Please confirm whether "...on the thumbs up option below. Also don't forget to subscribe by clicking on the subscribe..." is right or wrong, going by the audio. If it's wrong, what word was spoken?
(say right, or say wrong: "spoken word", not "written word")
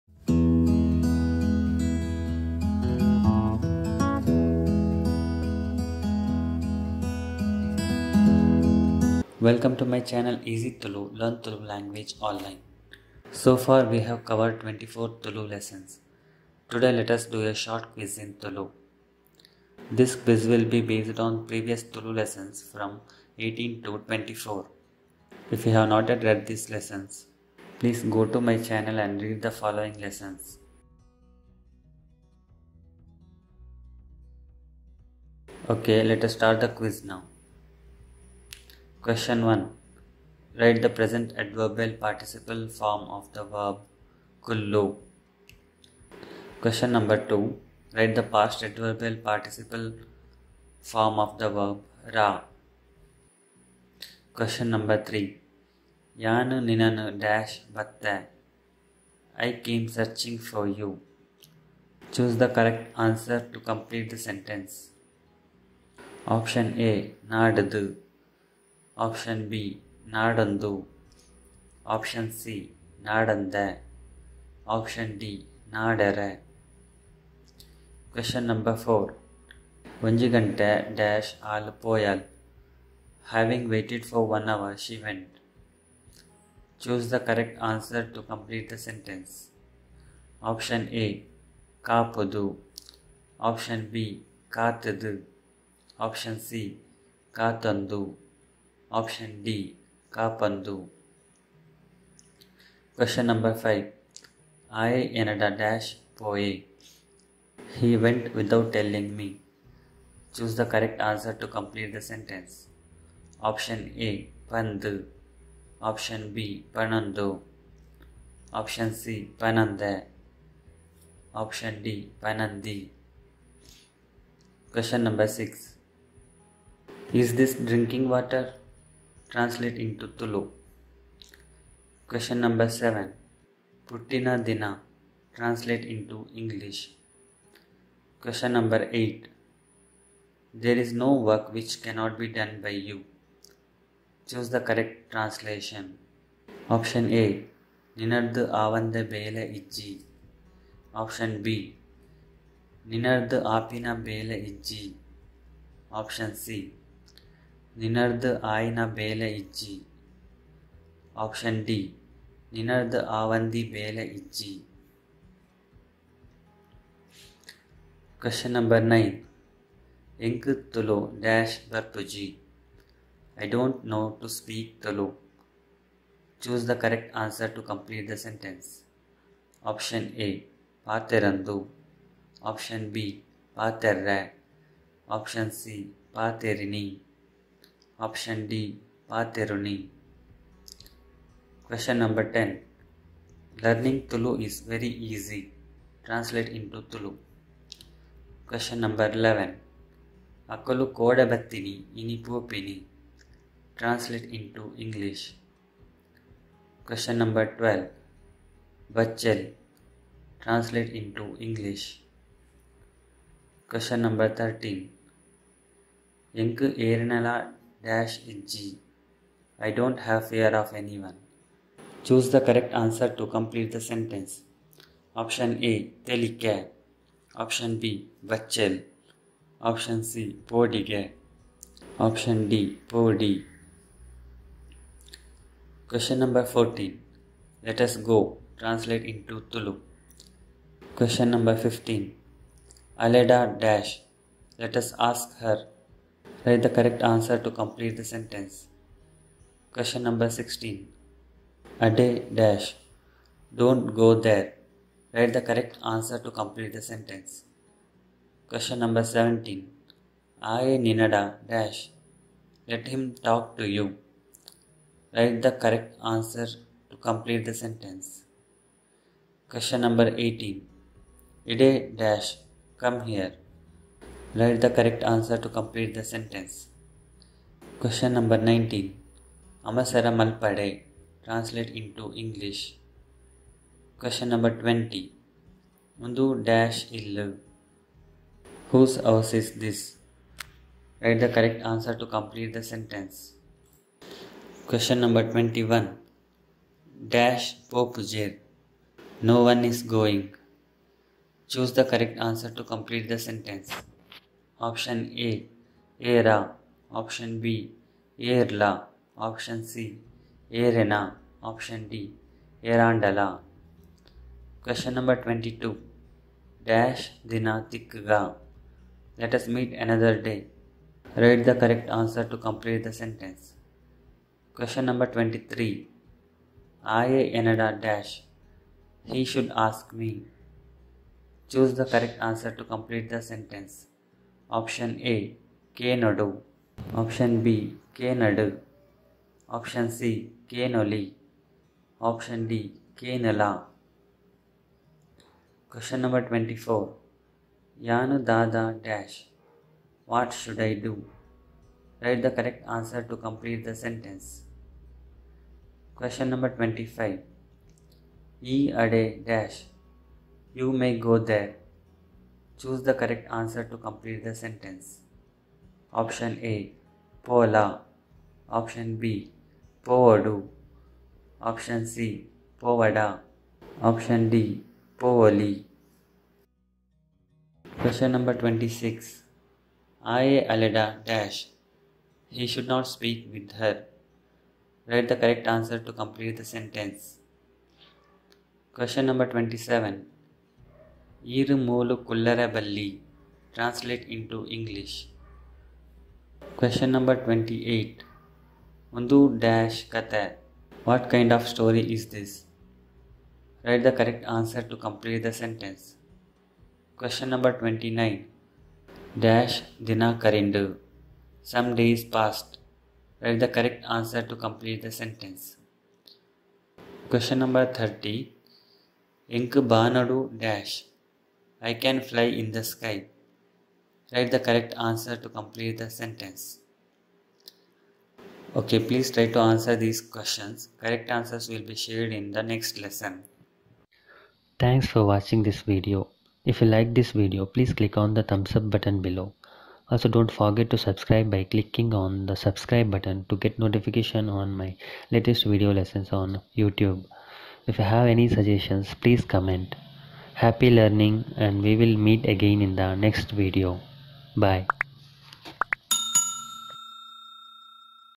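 wrong: "button", not "option".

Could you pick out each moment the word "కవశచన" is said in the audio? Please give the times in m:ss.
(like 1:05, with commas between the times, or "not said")
3:11, 3:18, 3:26, 3:33.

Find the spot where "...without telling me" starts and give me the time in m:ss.
1:48.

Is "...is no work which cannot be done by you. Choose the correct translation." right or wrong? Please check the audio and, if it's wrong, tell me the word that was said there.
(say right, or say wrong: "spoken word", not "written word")
right.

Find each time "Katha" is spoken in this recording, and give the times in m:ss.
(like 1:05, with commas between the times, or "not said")
6:39.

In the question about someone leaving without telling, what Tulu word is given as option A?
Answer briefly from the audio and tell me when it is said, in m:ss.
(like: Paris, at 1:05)
Pandu, at 1:54.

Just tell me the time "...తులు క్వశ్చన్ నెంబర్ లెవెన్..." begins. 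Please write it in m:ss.
3:16.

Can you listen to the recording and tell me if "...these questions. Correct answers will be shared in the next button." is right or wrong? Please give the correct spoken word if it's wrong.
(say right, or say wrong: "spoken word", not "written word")
wrong: "lesson", not "button".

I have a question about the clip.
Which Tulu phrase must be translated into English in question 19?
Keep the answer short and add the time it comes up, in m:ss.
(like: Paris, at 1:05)
Amasara Malpade, at 4:39.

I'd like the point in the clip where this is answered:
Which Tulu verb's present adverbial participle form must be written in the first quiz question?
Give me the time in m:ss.
0:44.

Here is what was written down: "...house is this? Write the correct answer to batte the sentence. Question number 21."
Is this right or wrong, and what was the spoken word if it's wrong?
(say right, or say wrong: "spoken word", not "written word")
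wrong: "complete", not "batte".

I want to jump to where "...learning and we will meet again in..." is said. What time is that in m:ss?
7:30.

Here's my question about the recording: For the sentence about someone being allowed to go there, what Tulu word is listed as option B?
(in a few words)
Povodu.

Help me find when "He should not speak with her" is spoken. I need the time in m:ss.
6:22.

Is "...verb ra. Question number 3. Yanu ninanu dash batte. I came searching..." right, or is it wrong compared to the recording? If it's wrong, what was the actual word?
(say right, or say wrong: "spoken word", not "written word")
right.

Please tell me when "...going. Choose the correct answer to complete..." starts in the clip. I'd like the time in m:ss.
4:59.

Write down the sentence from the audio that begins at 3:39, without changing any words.
I don't have fear of anyone.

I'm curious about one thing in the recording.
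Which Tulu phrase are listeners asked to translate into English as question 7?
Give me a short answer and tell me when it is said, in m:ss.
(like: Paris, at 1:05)
Putina Dina, at 2:13.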